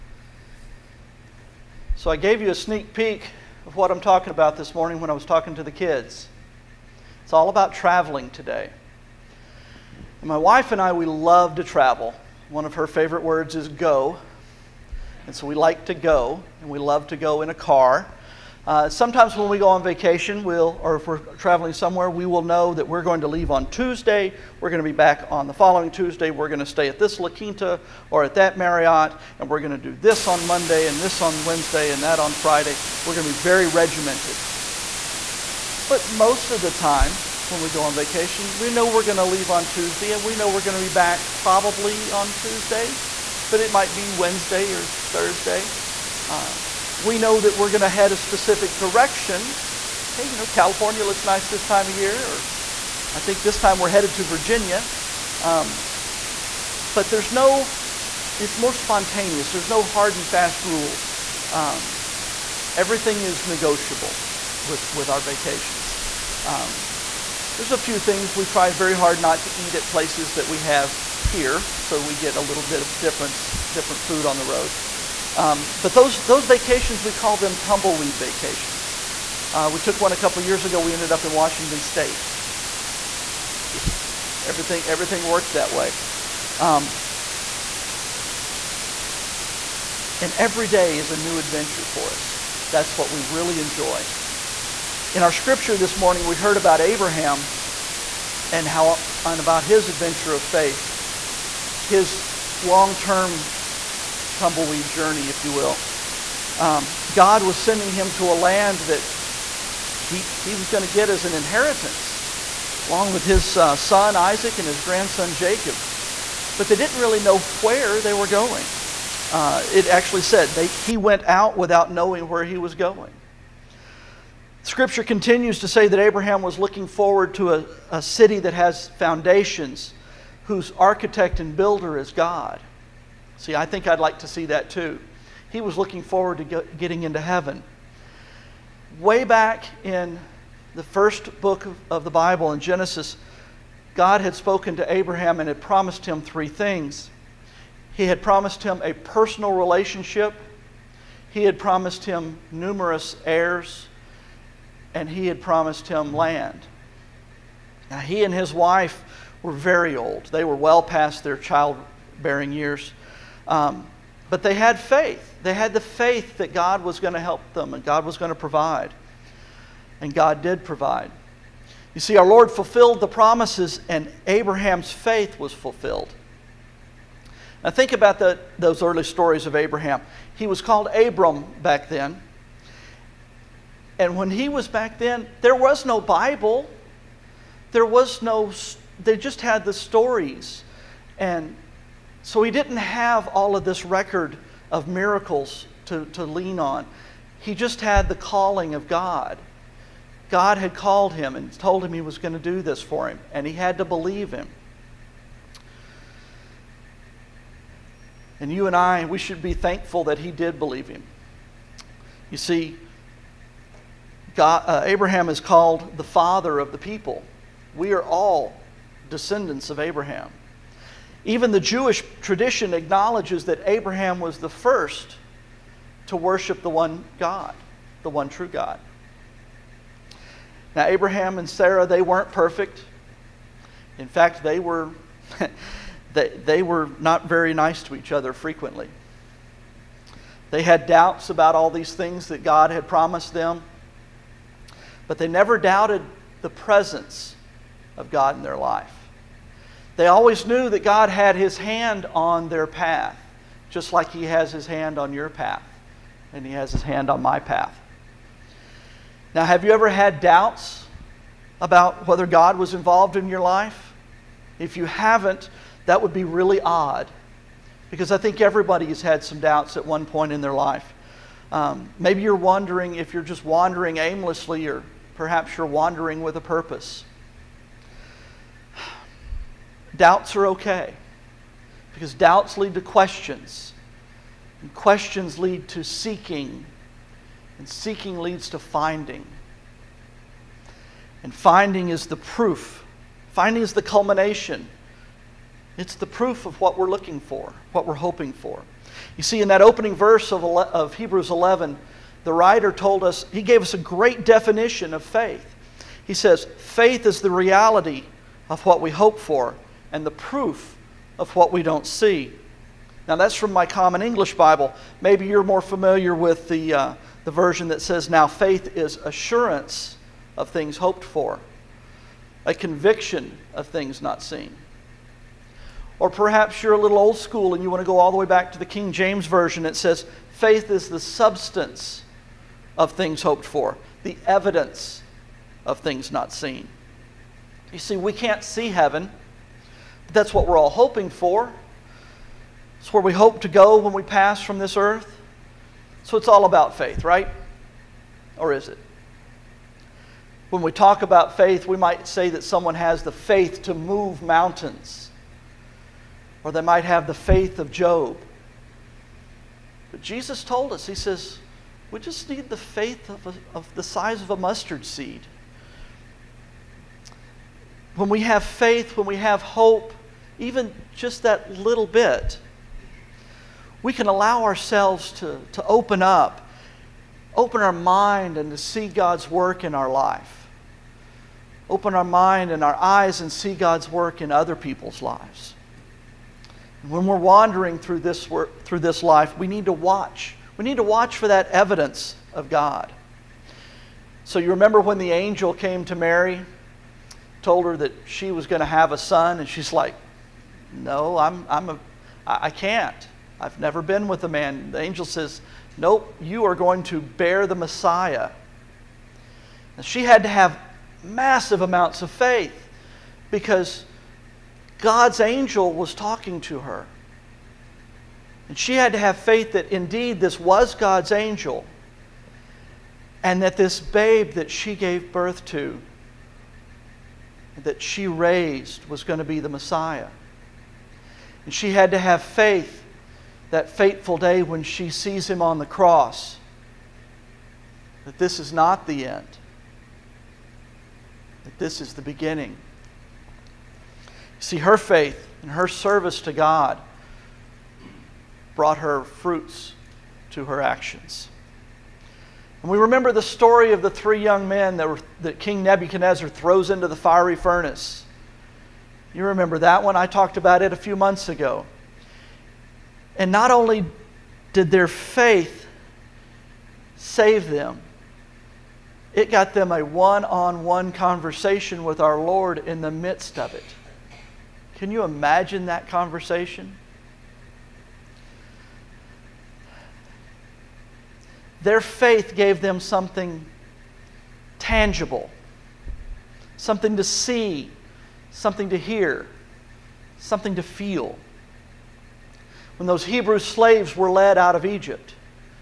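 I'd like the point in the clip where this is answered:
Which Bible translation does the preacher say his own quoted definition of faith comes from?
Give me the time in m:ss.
5:13.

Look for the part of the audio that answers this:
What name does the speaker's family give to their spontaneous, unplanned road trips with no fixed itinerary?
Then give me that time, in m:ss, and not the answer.
1:17.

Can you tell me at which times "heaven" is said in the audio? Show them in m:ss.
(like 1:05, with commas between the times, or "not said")
2:17, 5:38.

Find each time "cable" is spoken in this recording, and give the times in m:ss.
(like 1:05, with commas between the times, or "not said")
not said.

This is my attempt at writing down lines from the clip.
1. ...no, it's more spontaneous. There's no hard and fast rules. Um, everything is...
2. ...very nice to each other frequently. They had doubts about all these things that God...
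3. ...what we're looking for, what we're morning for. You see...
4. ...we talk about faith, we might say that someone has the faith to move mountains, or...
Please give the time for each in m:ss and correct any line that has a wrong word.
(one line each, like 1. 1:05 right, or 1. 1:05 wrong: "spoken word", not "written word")
1. 0:57 right
2. 3:57 right
3. 4:56 wrong: "hoping", not "morning"
4. 5:50 right.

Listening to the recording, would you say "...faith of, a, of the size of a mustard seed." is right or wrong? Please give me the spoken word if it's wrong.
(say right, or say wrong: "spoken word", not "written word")
right.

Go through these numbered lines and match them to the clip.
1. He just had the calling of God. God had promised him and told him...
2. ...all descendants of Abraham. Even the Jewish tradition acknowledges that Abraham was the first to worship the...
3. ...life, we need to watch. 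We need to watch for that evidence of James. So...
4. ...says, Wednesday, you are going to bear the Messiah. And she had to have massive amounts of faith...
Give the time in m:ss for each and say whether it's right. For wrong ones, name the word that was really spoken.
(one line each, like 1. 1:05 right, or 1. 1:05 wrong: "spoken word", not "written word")
1. 3:17 wrong: "called", not "promised"
2. 3:38 right
3. 6:29 wrong: "God", not "James"
4. 6:45 wrong: "Nope", not "Wednesday".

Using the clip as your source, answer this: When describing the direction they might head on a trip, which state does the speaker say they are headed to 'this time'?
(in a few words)
Virginia.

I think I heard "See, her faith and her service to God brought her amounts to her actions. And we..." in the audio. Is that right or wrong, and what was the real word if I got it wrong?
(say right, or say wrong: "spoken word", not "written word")
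wrong: "fruits", not "amounts".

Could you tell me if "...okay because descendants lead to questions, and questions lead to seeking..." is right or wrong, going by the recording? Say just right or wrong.
wrong.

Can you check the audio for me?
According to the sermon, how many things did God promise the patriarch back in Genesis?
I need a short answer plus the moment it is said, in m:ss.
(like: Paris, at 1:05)
3, at 2:26.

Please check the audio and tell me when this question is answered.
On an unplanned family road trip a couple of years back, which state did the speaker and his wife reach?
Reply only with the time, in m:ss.
1:21.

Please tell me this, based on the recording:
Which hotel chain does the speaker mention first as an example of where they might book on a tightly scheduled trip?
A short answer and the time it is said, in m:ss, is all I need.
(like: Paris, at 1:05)
La Quinta, at 0:27.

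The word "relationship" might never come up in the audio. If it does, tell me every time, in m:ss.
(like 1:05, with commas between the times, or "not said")
2:29.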